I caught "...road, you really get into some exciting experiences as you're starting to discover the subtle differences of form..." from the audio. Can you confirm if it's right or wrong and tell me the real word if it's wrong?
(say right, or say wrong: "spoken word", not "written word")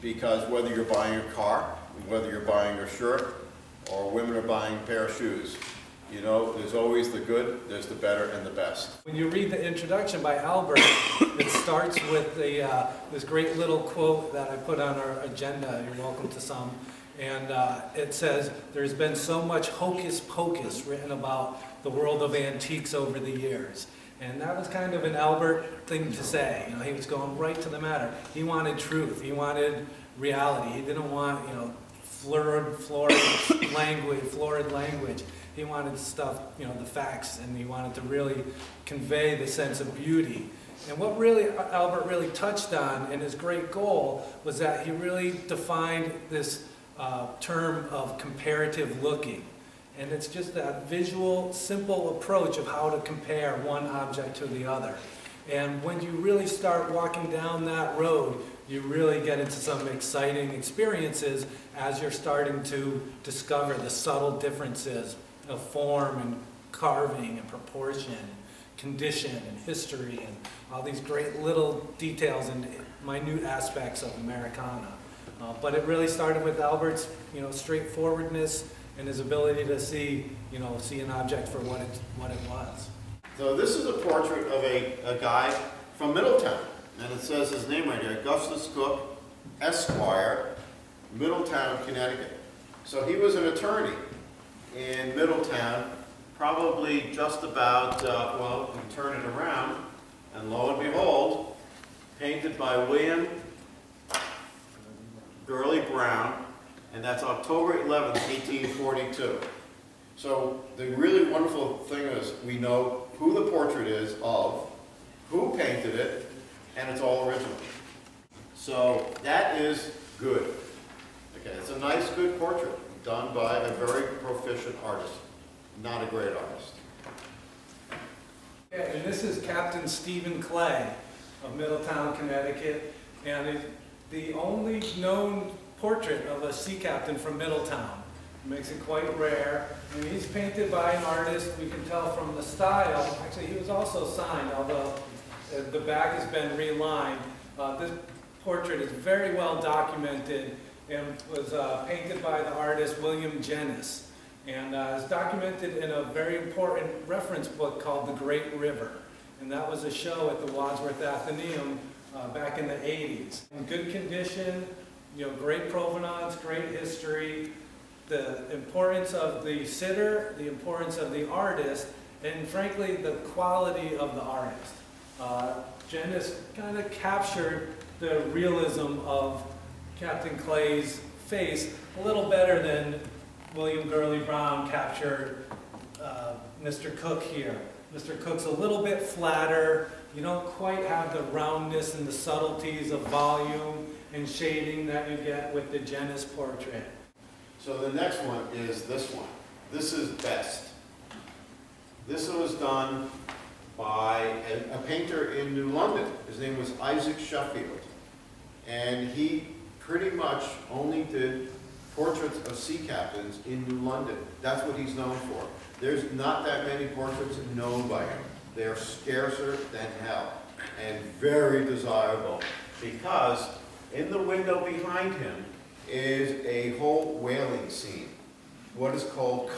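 right.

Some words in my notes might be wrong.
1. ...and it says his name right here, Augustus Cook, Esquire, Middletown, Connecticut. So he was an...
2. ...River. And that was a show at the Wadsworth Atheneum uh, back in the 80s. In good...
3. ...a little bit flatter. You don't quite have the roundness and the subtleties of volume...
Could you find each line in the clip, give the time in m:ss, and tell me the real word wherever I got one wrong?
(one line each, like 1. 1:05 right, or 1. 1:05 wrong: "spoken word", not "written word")
1. 1:26 right
2. 2:38 right
3. 3:08 right.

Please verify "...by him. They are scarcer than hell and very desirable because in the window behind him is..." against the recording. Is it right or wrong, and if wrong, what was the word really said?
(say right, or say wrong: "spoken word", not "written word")
right.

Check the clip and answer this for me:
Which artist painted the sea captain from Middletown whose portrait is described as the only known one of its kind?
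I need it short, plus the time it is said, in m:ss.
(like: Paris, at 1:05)
William Jennys, at 2:33.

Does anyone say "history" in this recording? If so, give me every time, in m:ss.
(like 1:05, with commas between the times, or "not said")
1:09, 2:46.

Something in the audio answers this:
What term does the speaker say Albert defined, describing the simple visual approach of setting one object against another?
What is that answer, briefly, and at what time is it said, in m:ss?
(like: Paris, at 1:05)
comparative looking, at 0:48.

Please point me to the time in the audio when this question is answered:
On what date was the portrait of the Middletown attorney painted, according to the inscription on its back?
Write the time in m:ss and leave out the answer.
1:47.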